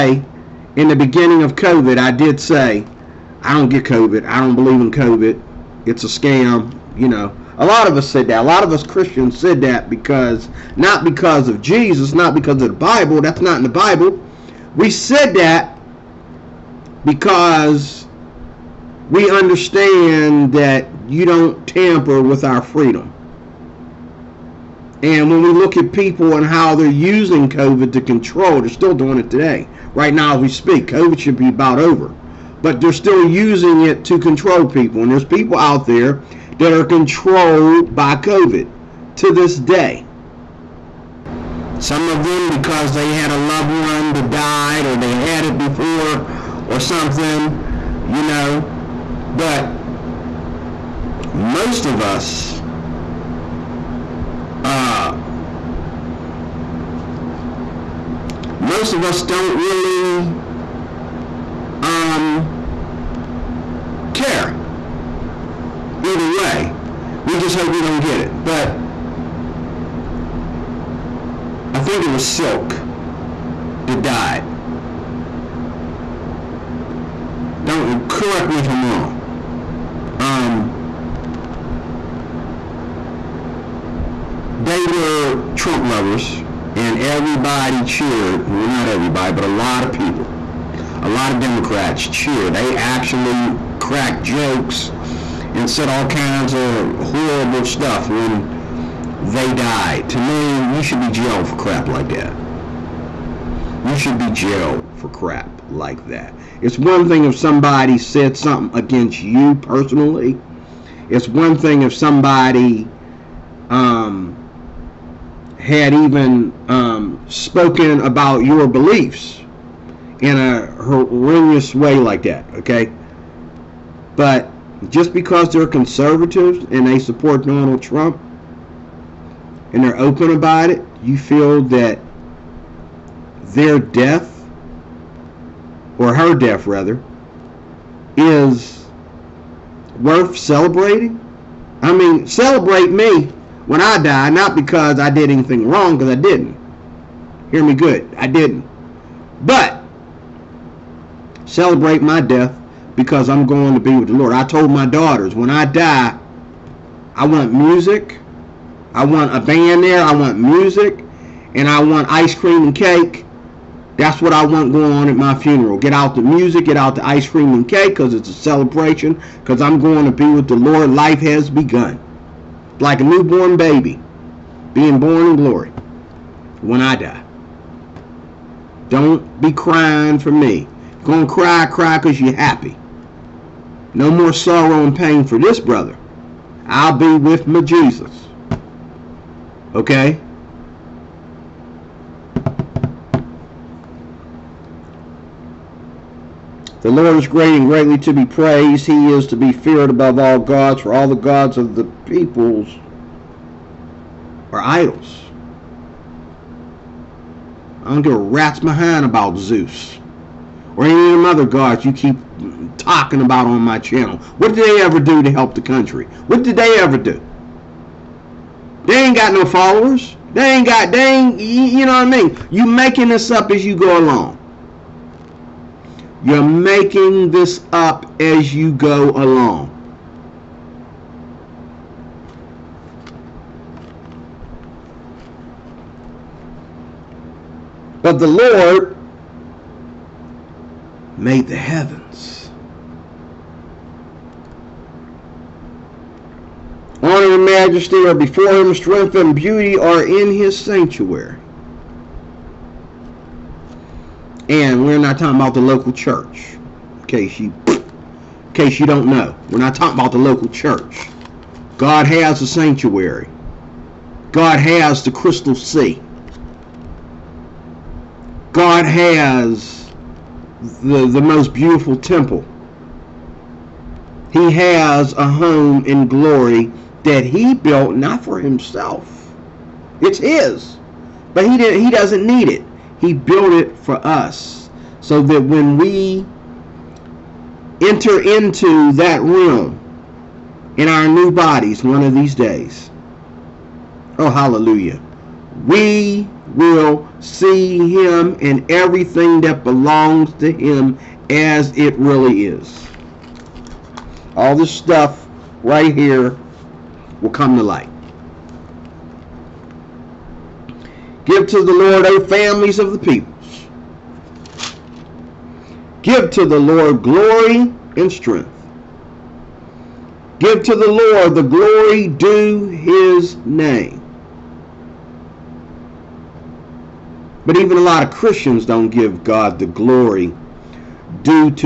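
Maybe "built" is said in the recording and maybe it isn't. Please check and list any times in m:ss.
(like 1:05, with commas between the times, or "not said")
4:37, 4:43.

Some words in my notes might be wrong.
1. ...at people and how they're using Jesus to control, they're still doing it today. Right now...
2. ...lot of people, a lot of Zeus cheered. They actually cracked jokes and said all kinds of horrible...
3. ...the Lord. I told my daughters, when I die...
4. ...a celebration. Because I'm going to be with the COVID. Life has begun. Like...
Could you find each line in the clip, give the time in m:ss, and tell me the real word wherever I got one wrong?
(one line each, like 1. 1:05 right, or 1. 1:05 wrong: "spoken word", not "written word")
1. 0:25 wrong: "COVID", not "Jesus"
2. 1:29 wrong: "Democrats", not "Zeus"
3. 2:34 right
4. 2:48 wrong: "Lord", not "COVID".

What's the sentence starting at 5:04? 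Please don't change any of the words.
All this stuff right here will come to light.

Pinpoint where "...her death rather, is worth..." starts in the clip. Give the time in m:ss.
2:16.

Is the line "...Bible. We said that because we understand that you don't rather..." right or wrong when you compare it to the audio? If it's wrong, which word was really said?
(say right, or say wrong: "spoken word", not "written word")
wrong: "tamper", not "rather".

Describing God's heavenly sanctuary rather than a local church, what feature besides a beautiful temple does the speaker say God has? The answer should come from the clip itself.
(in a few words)
crystal sea.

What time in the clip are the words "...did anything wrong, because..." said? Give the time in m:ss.
2:25.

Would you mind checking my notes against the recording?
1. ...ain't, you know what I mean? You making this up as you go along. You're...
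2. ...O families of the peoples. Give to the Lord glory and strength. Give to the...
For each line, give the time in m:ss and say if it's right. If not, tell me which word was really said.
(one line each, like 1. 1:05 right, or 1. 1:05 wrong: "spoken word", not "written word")
1. 3:41 right
2. 5:12 right.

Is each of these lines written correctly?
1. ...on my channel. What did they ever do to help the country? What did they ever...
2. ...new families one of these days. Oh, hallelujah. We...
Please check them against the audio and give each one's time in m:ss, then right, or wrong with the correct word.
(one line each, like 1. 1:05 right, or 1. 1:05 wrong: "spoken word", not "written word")
1. 3:33 right
2. 4:51 wrong: "bodies", not "families".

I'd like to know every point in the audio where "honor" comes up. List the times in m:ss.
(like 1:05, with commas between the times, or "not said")
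4:07.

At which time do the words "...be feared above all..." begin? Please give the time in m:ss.
3:19.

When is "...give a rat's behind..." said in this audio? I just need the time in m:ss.
3:28.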